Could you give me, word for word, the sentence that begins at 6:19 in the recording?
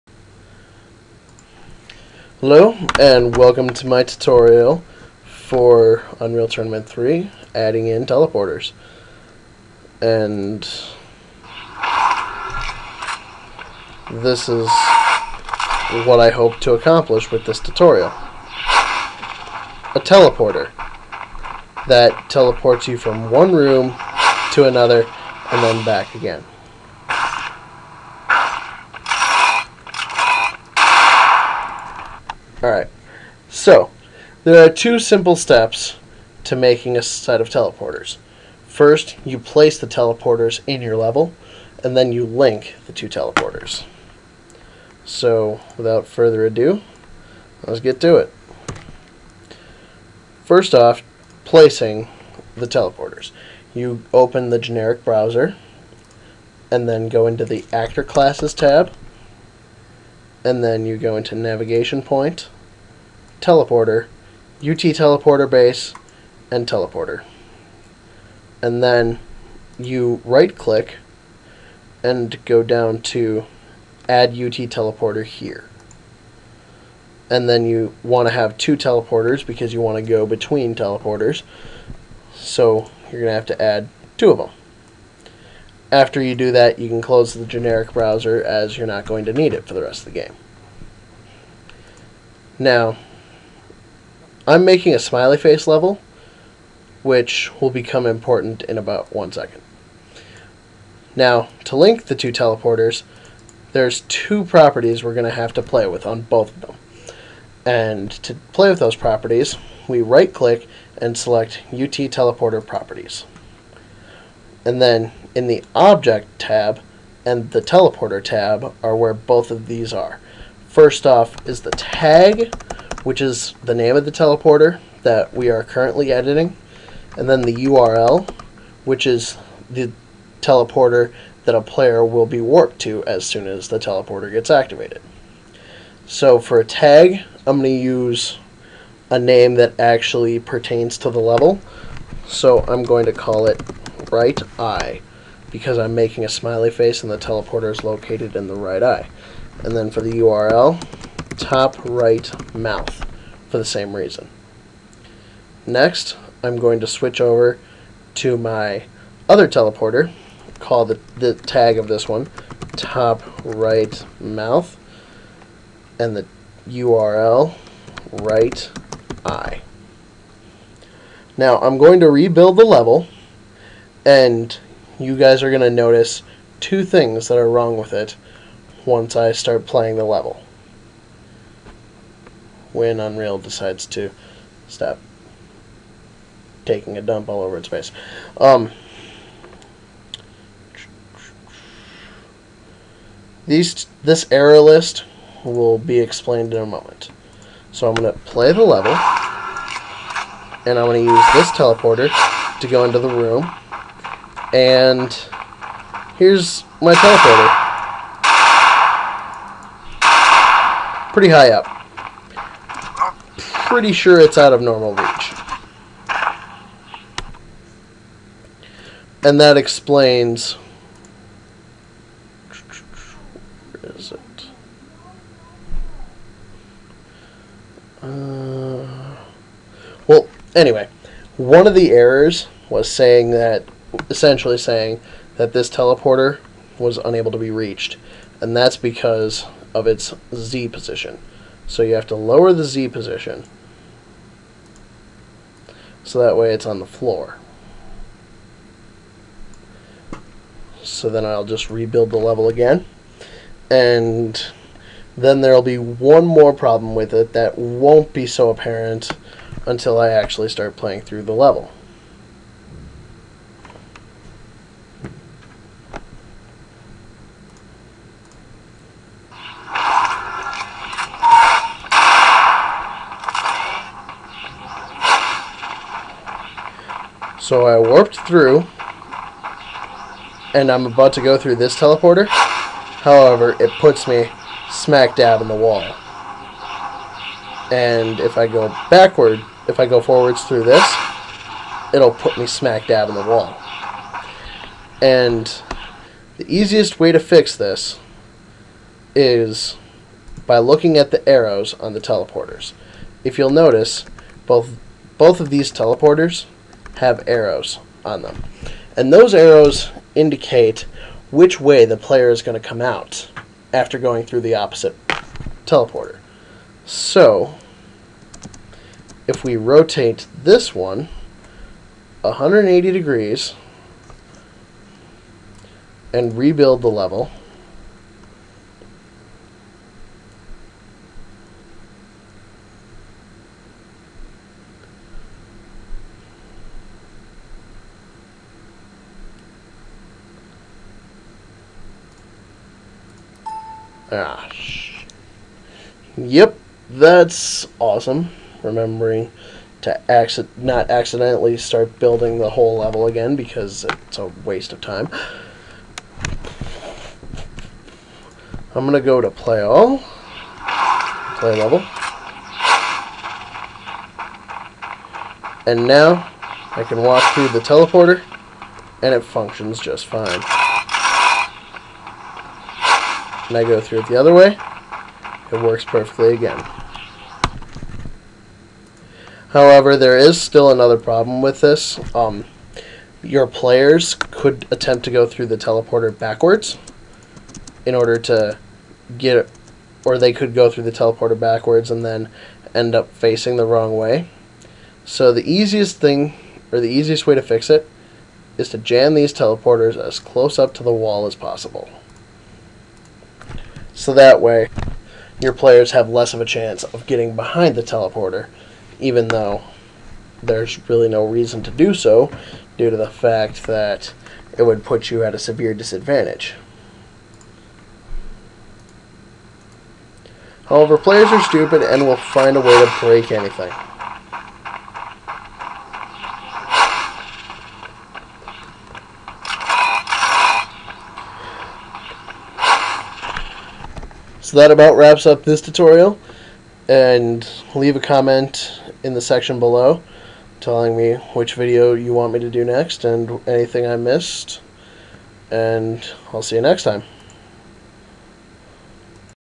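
However, there is still another problem with this.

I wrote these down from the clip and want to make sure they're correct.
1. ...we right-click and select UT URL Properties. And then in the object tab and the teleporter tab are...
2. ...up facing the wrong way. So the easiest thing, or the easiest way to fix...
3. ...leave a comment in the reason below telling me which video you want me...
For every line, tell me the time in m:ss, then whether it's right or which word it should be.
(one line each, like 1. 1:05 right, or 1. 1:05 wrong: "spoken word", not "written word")
1. 1:49 wrong: "Teleporter", not "URL"
2. 6:32 right
3. 7:17 wrong: "section", not "reason".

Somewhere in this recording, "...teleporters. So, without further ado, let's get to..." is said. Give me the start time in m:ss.
0:43.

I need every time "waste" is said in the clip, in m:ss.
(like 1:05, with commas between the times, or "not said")
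5:54.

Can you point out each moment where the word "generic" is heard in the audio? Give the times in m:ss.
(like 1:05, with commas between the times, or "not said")
0:54, 1:27.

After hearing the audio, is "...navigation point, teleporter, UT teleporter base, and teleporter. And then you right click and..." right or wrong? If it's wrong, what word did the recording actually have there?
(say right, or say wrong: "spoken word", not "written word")
right.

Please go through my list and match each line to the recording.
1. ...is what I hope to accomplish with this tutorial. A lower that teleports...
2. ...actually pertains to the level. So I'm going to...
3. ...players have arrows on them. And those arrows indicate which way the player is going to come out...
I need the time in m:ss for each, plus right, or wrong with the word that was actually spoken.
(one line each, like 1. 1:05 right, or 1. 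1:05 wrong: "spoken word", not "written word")
1. 0:14 wrong: "teleporter", not "lower"
2. 2:19 right
3. 5:05 wrong: "teleporters", not "players".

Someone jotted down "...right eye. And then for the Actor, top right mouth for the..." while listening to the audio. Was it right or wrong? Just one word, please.
wrong.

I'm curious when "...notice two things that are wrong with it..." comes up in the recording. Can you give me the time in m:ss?
2:55.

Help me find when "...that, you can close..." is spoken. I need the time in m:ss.
1:26.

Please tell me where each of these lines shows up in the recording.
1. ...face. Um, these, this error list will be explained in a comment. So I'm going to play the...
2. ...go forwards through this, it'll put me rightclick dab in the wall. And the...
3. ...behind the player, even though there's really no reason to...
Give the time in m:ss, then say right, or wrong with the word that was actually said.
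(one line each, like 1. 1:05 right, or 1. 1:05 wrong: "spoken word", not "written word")
1. 3:07 wrong: "moment", not "comment"
2. 4:49 wrong: "smack", not "rightclick"
3. 6:47 wrong: "teleporter", not "player".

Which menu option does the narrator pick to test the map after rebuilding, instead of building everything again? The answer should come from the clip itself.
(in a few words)
Play level.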